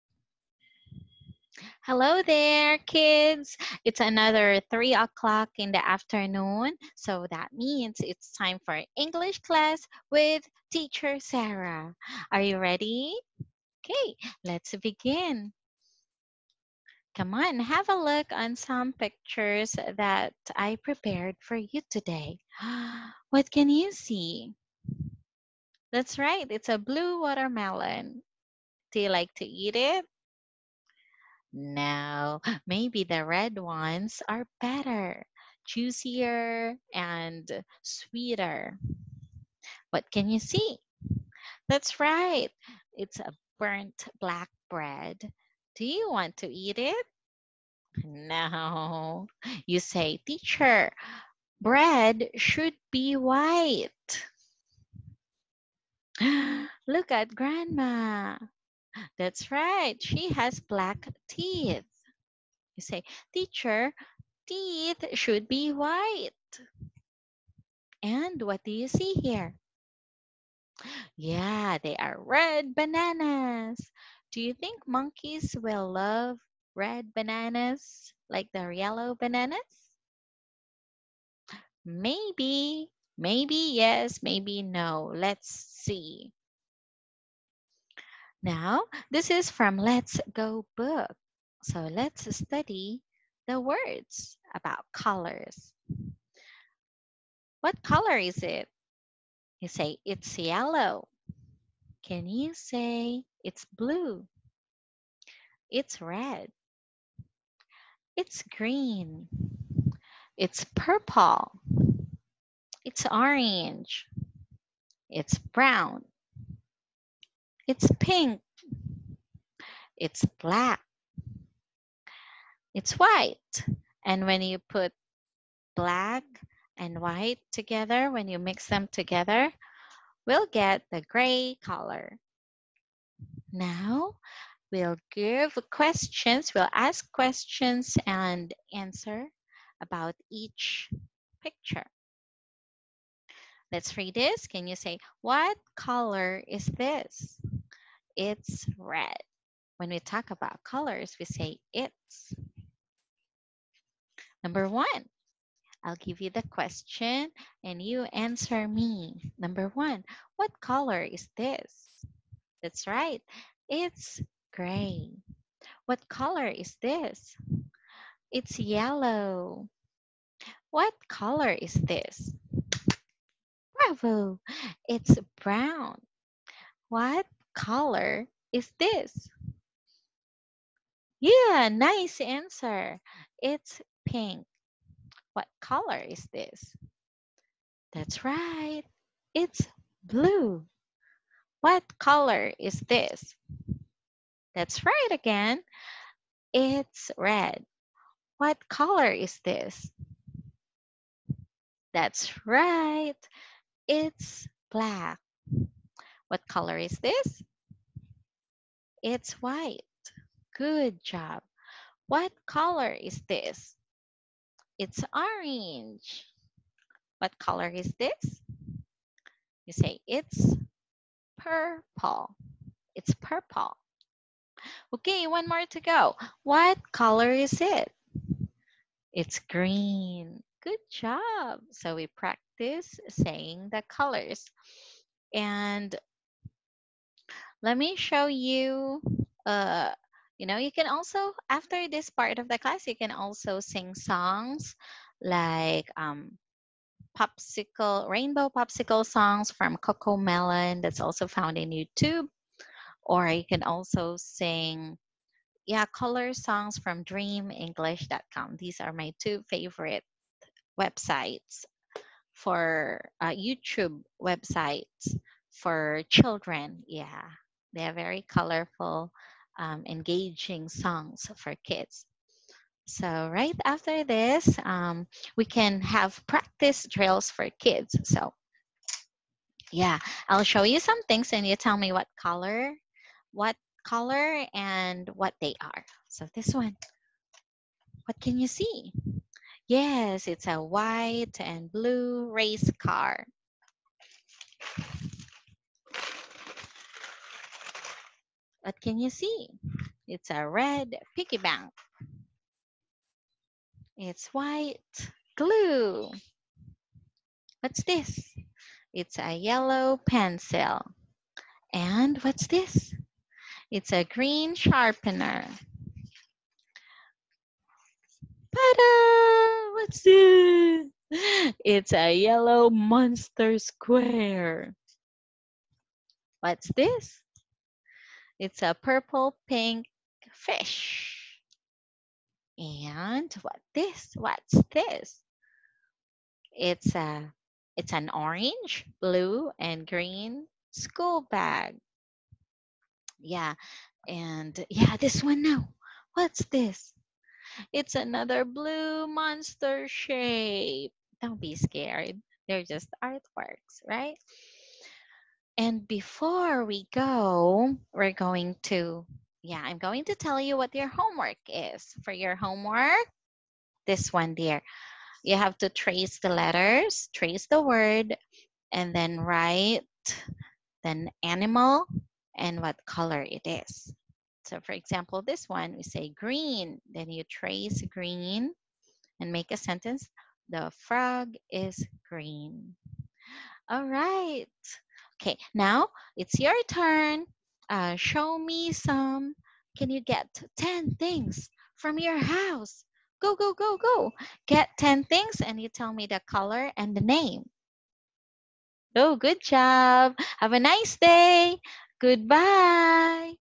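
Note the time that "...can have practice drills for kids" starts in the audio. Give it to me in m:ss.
4:35.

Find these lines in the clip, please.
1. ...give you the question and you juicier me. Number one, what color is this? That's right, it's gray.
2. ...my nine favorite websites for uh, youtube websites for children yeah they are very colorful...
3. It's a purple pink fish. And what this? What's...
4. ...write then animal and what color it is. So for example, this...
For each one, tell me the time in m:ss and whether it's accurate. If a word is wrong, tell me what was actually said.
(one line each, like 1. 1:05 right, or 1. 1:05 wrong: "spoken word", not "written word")
1. 2:35 wrong: "answer", not "juicier"
2. 4:18 wrong: "two", not "nine"
3. 5:28 right
4. 6:09 right.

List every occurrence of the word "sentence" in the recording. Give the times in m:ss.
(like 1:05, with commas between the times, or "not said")
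6:19.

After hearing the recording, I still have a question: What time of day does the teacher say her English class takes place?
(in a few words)
3:00 in the afternoon.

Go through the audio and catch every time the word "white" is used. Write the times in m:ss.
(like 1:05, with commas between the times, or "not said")
0:53, 1:05, 2:02, 2:06, 3:29, 4:50, 5:04.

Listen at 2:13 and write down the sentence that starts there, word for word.
Now, we'll give questions, we'll ask questions and answer about each picture.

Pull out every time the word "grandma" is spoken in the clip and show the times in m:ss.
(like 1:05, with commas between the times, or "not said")
0:57.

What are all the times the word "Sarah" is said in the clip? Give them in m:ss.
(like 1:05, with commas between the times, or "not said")
0:11.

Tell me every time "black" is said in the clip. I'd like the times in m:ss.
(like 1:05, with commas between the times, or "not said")
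0:44, 1:00, 2:00, 2:05, 3:24.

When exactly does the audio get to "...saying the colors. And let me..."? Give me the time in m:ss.
3:53.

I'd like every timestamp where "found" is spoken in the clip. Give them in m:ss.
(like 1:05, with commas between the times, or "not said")
4:11.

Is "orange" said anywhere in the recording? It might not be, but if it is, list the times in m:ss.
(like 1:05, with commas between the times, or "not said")
1:53, 3:35, 5:38.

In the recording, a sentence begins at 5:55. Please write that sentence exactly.
And before we go, we're going to, yeah, I'm going to tell you what your homework is.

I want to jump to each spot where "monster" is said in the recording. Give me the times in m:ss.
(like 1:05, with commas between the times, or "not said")
5:22, 5:49.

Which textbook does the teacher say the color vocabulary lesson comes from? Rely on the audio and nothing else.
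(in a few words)
Let's Go.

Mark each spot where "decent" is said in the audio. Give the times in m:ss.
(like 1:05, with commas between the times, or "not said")
not said.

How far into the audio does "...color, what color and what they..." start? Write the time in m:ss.
4:42.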